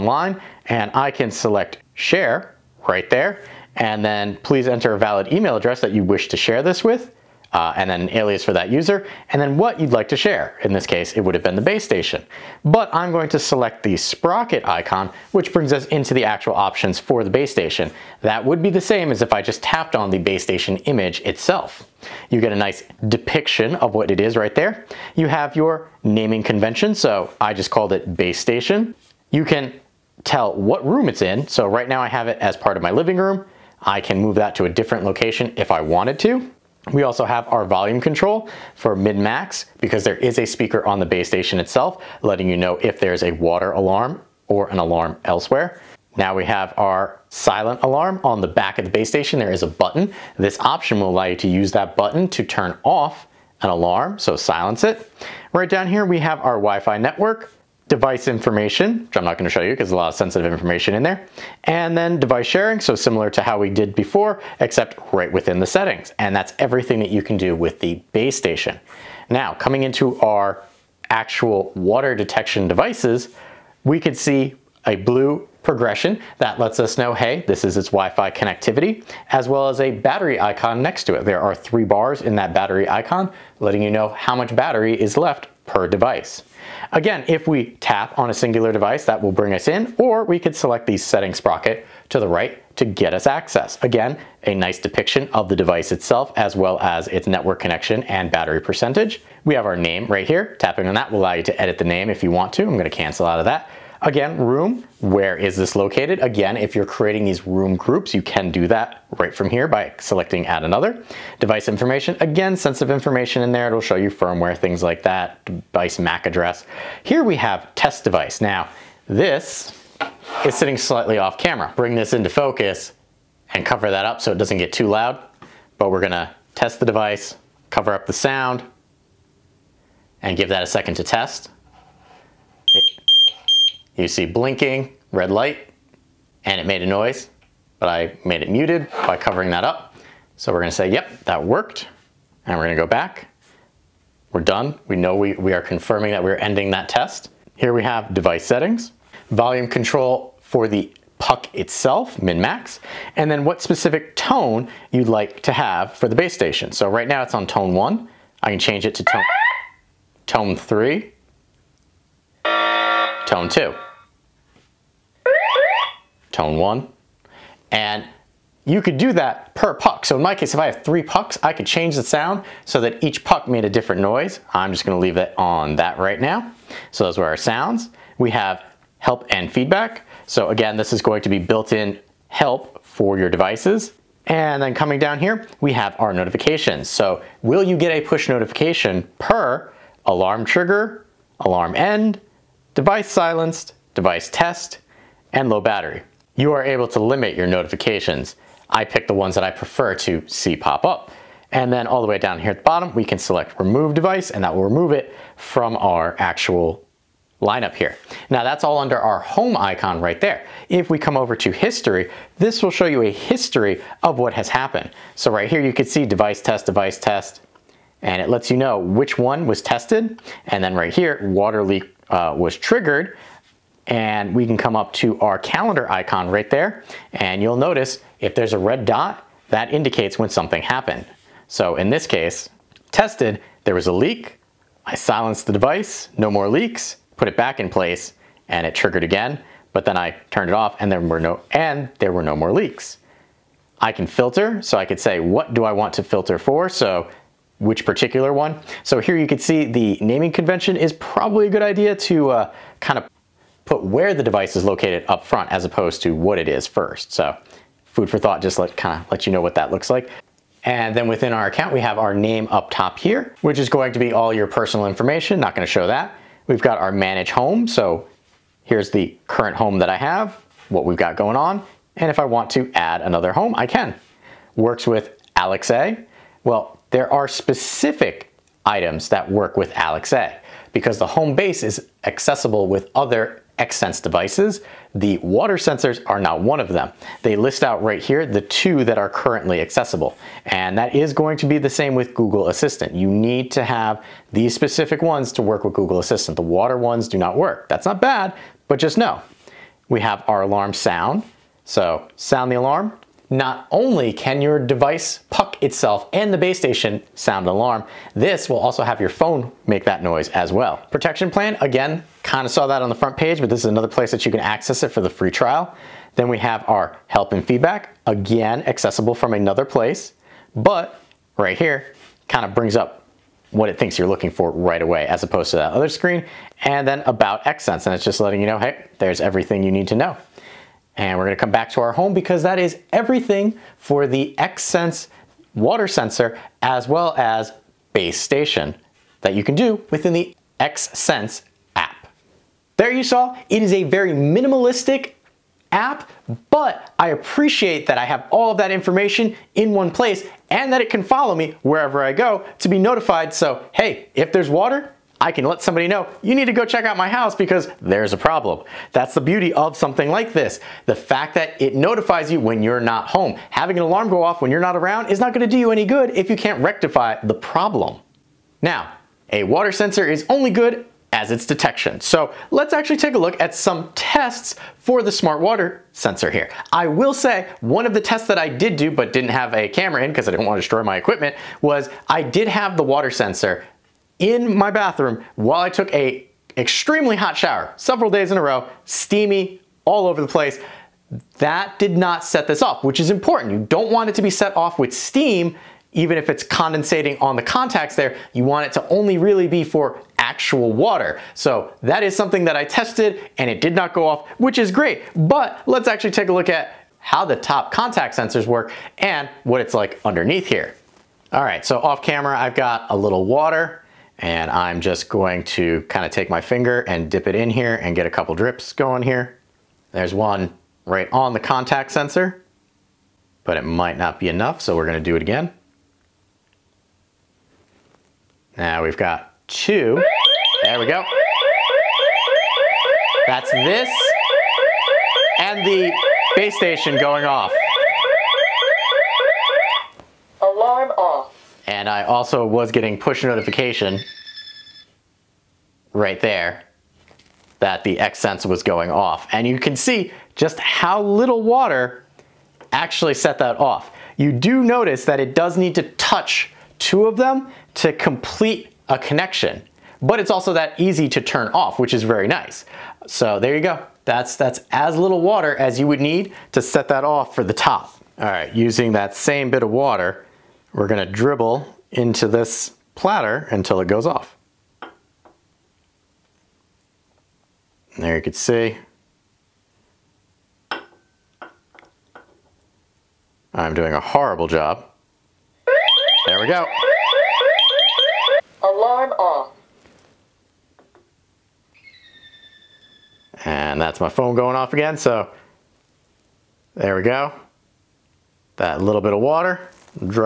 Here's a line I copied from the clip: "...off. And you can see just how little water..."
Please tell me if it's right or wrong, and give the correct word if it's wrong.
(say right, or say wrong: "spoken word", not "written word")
right.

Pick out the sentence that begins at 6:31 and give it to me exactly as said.
That did not set this off, which is important.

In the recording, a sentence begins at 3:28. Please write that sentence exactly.
Now that's all under our home icon right there.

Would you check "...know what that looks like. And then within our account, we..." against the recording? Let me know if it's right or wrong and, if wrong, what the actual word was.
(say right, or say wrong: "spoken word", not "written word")
right.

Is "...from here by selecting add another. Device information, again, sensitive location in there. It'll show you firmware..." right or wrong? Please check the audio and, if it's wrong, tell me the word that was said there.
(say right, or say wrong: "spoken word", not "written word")
wrong: "information", not "location".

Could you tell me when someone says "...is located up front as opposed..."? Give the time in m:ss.
4:14.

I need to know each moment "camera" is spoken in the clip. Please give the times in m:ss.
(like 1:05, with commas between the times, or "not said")
2:01, 6:19, 6:52.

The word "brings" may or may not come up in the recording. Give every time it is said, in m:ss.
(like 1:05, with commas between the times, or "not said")
0:15, 1:29, 2:01, 5:22.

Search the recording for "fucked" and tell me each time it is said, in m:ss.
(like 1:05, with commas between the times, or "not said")
not said.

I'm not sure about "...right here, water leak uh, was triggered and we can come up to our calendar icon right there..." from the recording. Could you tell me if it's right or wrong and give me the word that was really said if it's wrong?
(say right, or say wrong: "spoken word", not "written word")
right.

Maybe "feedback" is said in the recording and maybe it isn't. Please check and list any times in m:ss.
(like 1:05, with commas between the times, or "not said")
2:59, 5:17.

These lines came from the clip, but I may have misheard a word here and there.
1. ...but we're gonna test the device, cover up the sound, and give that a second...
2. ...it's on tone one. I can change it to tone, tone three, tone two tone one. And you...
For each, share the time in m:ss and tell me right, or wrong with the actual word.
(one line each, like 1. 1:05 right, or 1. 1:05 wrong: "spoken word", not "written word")
1. 2:05 right
2. 2:37 right.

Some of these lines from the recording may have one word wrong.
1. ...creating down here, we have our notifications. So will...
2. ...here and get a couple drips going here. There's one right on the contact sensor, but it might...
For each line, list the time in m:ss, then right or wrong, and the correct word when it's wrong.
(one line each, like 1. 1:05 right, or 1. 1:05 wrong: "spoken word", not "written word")
1. 3:04 wrong: "coming", not "creating"
2. 6:57 right.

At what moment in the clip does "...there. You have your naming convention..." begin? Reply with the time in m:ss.
0:24.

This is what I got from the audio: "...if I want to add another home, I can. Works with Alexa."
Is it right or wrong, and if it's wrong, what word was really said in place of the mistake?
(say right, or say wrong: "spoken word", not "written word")
right.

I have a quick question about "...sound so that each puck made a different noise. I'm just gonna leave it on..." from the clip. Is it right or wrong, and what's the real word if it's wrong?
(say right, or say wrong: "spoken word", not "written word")
right.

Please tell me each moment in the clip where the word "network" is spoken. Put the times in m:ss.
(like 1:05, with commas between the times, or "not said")
0:56, 1:37.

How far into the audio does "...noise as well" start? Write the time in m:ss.
5:10.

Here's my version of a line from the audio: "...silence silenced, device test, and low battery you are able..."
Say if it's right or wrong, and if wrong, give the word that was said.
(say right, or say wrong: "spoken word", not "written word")
wrong: "device", not "silence".